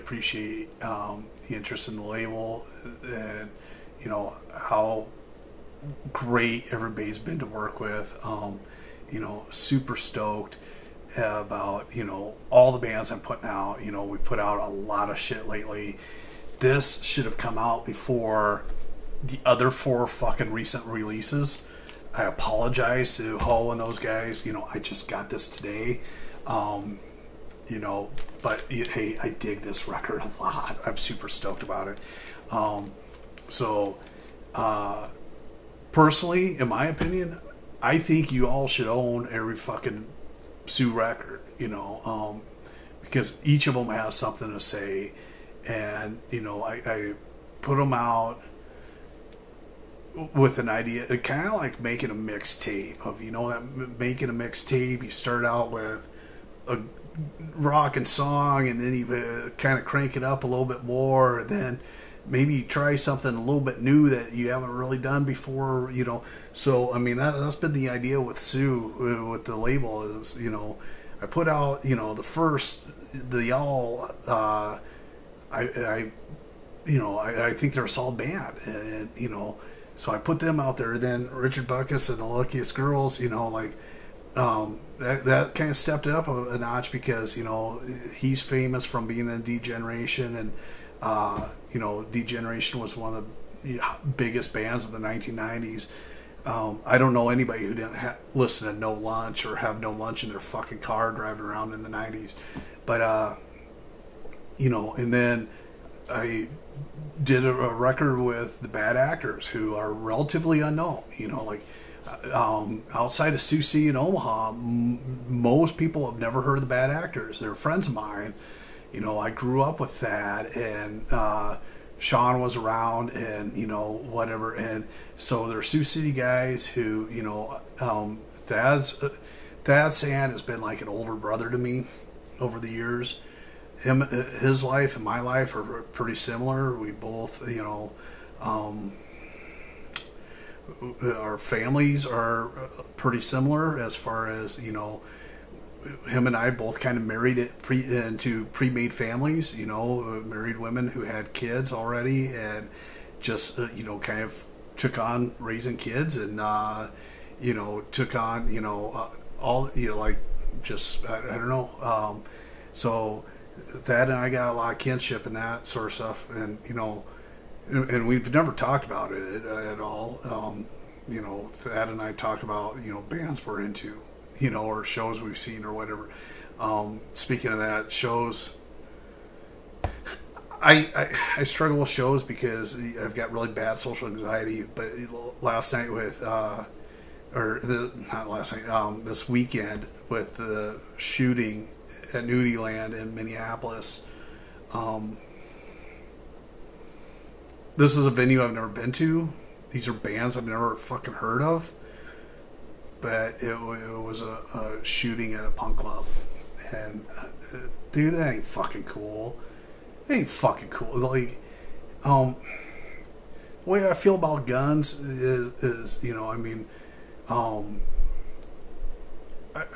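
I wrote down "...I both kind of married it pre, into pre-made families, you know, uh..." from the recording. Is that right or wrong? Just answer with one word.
right.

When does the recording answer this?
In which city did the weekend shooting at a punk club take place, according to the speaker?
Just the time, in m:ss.
3:13.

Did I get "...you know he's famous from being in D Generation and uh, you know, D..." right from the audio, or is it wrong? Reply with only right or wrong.
right.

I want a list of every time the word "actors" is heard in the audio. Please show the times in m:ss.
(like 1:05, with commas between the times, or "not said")
1:48, 1:56.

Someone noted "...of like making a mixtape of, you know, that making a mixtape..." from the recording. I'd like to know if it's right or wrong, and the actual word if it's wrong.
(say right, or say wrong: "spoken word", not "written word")
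right.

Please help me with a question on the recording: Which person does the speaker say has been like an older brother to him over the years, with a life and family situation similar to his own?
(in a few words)
Thad Sand.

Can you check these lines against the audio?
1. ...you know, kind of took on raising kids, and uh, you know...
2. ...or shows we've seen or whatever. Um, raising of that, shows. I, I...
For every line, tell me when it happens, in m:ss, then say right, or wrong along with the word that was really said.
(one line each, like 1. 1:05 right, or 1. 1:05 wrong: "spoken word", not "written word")
1. 2:33 right
2. 2:54 wrong: "speaking", not "raising".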